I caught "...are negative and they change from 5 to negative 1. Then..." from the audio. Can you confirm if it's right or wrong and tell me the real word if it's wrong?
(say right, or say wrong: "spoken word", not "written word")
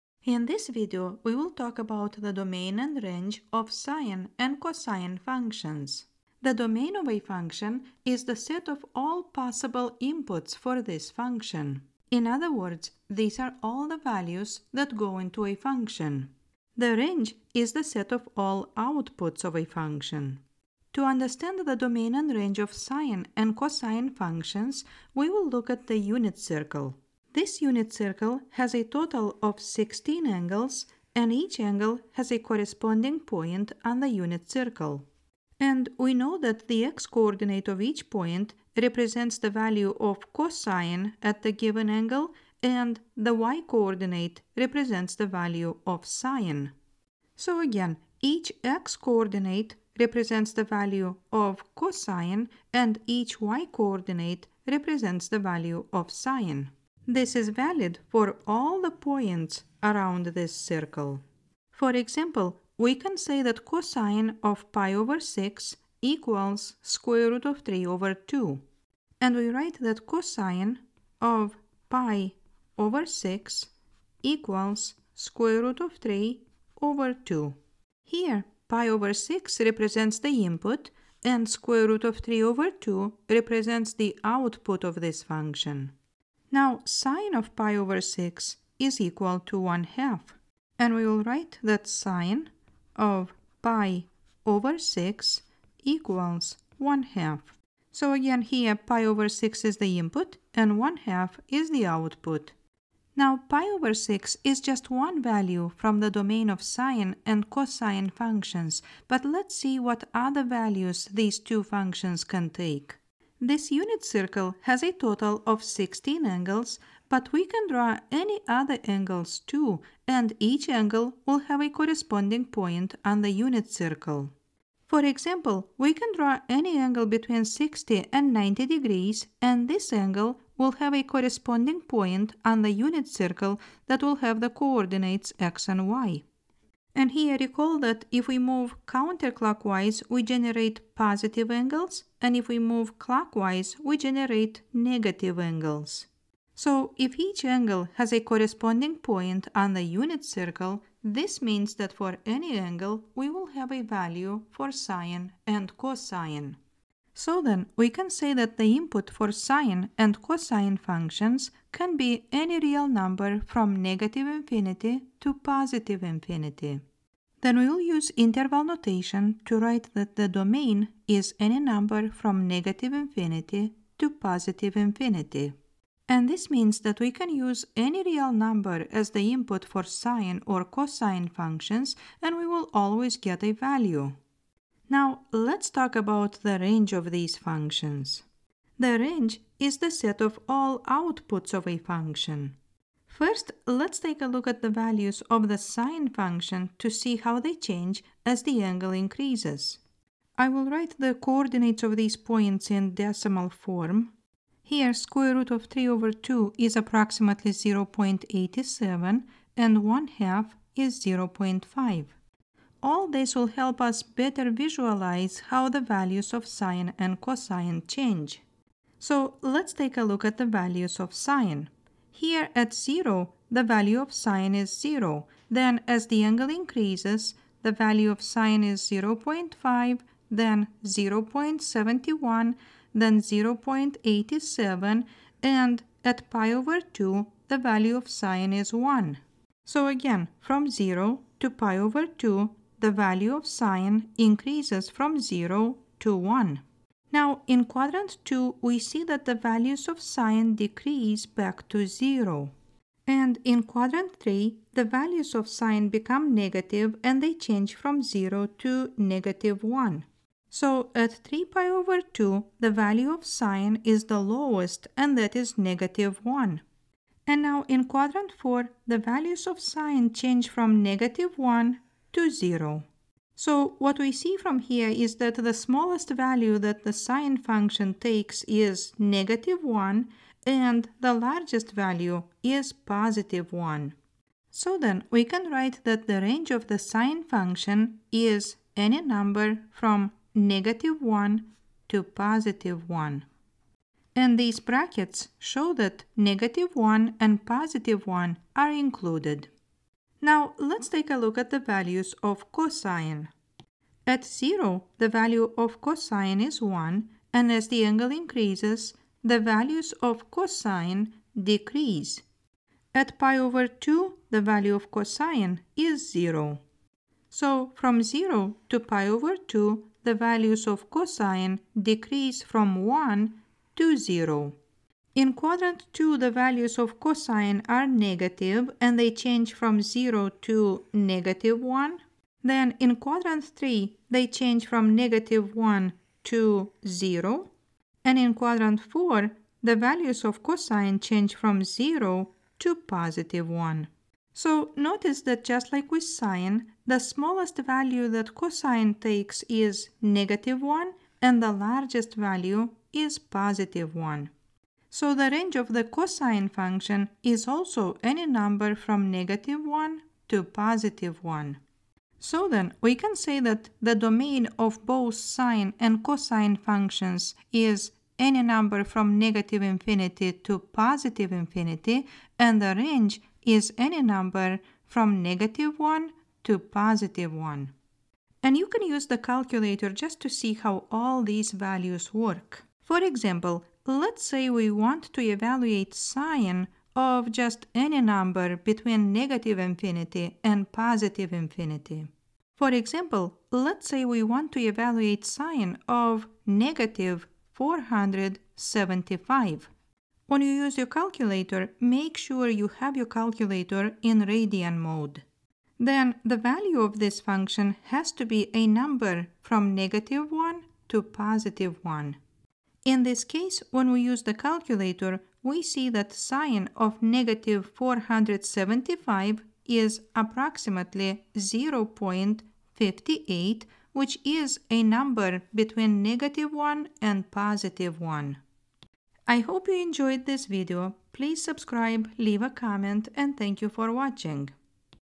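wrong: "0", not "5".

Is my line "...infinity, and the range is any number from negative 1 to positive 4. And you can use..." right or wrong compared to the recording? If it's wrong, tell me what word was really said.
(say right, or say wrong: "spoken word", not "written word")
wrong: "1", not "4".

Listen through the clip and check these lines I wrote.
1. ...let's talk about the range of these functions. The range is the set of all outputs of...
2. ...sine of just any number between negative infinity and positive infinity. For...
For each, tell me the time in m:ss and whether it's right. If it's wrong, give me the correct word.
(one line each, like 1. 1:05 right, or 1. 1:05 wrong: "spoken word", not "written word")
1. 3:05 right
2. 6:25 right.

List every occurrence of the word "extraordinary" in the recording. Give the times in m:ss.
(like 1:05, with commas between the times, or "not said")
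not said.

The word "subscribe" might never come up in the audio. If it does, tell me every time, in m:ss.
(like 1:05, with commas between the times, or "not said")
7:11.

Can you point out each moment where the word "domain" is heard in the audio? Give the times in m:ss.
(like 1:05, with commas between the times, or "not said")
0:02, 0:06, 0:21, 1:46, 2:50, 6:03.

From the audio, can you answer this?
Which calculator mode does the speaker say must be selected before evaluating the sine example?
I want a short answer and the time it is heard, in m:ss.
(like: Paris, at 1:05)
radian mode, at 6:44.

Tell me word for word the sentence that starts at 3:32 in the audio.
All this will help us better visualize how the values of sine and cosine change.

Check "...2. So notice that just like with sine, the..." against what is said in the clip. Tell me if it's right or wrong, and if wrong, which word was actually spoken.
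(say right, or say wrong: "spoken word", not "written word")
wrong: "1", not "2".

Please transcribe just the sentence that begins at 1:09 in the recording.
And we write that cosine of pi over 6 equals square root of 3 over 2.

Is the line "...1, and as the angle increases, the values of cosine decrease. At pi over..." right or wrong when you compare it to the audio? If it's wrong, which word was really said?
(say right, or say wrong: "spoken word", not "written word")
right.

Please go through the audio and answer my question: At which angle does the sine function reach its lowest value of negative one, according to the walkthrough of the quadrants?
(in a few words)
3π/2.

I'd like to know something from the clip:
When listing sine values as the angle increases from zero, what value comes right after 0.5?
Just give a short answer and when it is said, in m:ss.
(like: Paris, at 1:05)
0.71, at 3:50.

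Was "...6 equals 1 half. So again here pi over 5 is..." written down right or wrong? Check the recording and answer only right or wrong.
wrong.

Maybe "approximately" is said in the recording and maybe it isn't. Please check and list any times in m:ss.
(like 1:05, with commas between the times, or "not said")
3:26, 7:00.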